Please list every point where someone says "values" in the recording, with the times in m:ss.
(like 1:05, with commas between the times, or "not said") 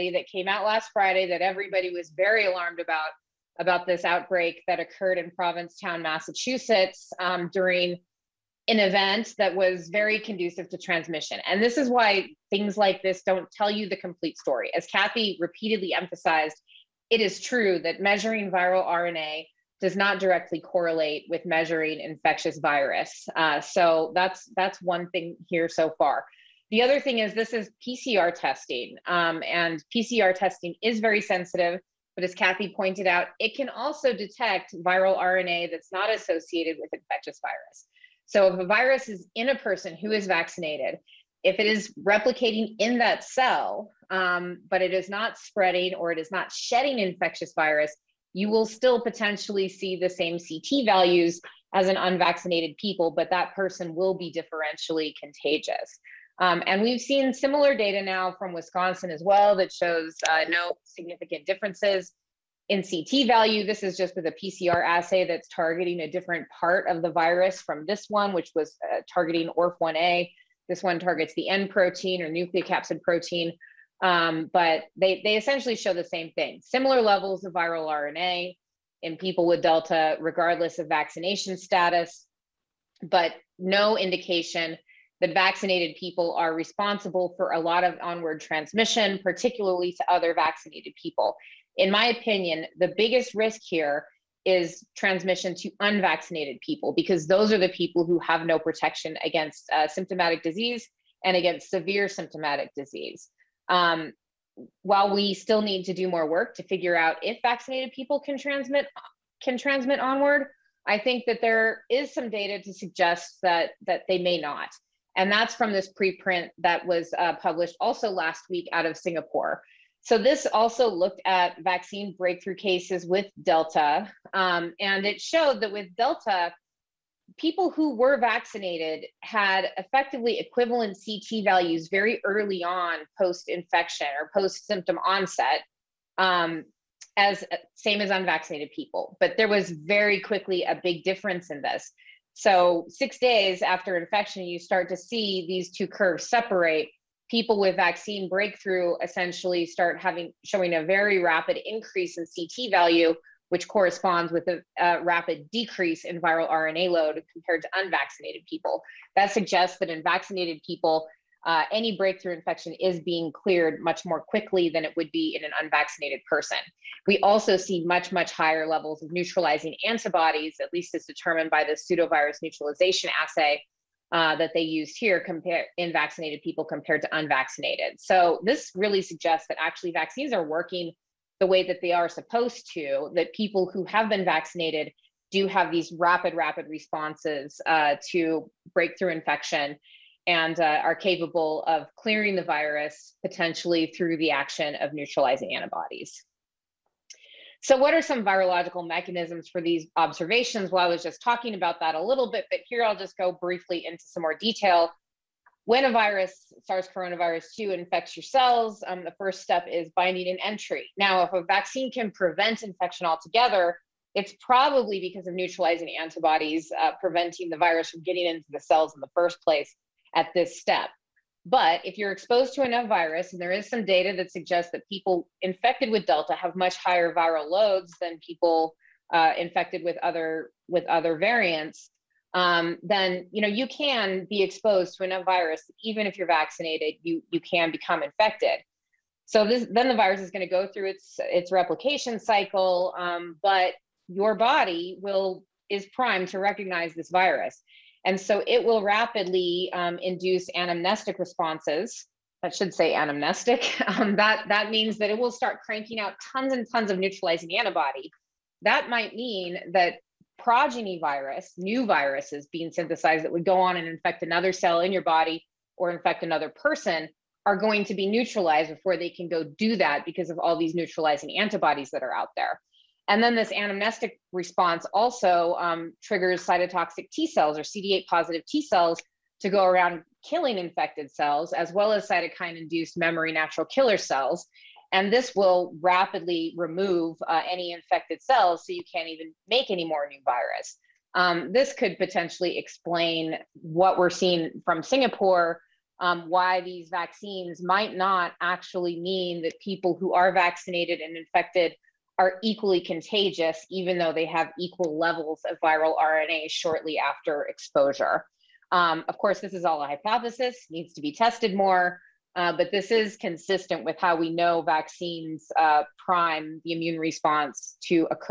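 0:50, 1:03, 2:11, 2:32.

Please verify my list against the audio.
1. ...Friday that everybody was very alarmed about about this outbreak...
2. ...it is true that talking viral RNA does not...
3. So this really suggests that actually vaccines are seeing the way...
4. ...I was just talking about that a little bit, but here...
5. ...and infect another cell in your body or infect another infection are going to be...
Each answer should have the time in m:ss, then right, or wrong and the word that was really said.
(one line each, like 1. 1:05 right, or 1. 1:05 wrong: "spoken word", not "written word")
1. 0:00 right
2. 0:17 wrong: "measuring", not "talking"
3. 2:58 wrong: "working", not "seeing"
4. 3:20 right
5. 4:23 wrong: "person", not "infection".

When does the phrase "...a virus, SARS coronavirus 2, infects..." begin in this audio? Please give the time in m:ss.
3:25.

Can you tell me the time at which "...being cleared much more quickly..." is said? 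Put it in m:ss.
2:43.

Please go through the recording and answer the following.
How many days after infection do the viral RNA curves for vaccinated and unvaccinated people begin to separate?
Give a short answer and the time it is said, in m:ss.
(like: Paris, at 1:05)
6, at 2:22.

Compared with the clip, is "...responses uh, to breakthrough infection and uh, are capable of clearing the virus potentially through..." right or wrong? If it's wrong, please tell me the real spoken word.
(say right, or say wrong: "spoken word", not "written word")
right.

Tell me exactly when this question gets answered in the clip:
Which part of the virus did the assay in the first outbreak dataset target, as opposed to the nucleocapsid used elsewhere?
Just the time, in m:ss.
1:09.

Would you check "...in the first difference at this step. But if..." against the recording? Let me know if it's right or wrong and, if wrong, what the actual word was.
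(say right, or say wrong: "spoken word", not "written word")
wrong: "place", not "difference".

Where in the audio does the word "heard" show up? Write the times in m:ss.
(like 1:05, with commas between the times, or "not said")
not said.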